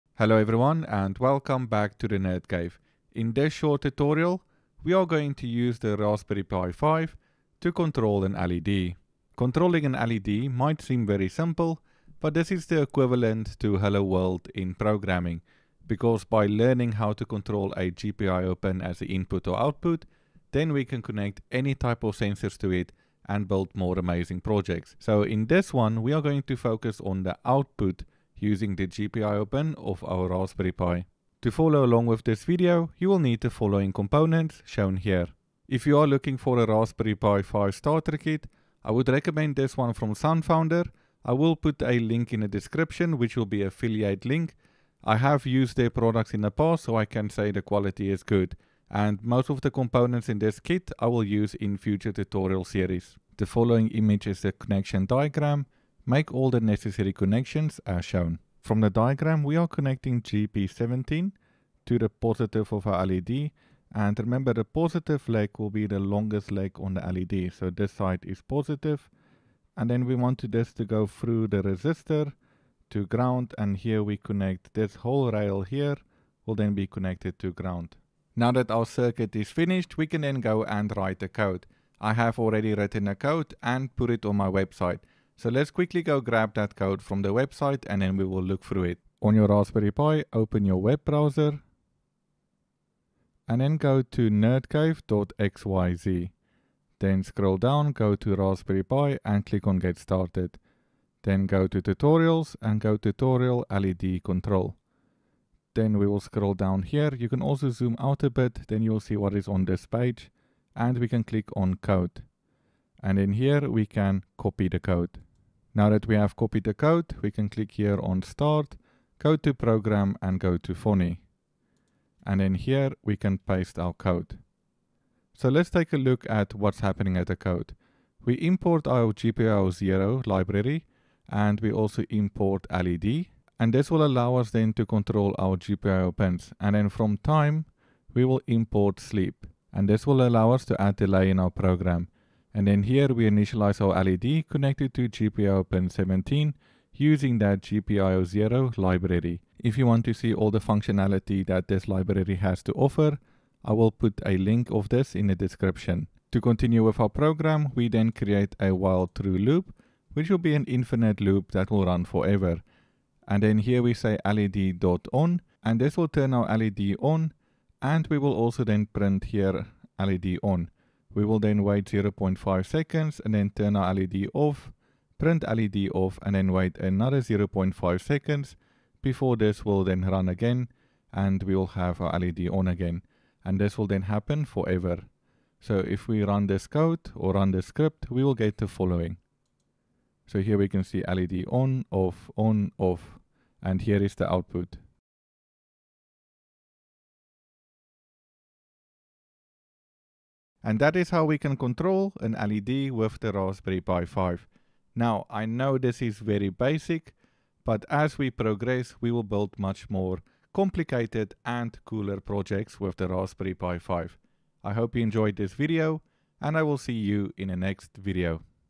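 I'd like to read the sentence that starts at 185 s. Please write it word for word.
So if we run this code or run this script, we will get the following.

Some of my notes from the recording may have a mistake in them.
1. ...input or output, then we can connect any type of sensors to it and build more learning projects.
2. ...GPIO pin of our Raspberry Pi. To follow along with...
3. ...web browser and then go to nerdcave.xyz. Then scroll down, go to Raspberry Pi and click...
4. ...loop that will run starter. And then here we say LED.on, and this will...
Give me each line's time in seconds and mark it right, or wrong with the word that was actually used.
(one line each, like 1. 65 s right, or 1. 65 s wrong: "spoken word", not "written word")
1. 19 s wrong: "amazing", not "learning"
2. 28 s right
3. 90 s right
4. 161 s wrong: "forever", not "starter".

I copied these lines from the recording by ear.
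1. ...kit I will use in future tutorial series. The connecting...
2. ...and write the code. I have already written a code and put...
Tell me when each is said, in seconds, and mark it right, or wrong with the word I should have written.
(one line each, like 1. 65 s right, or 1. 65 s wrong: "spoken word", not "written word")
1. 50 s wrong: "following", not "connecting"
2. 80 s right.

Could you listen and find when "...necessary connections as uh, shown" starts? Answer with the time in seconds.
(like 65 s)
56 s.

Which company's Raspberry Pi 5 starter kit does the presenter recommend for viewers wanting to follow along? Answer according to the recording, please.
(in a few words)
SunFounder.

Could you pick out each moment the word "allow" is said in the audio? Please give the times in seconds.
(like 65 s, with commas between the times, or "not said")
134 s, 140 s.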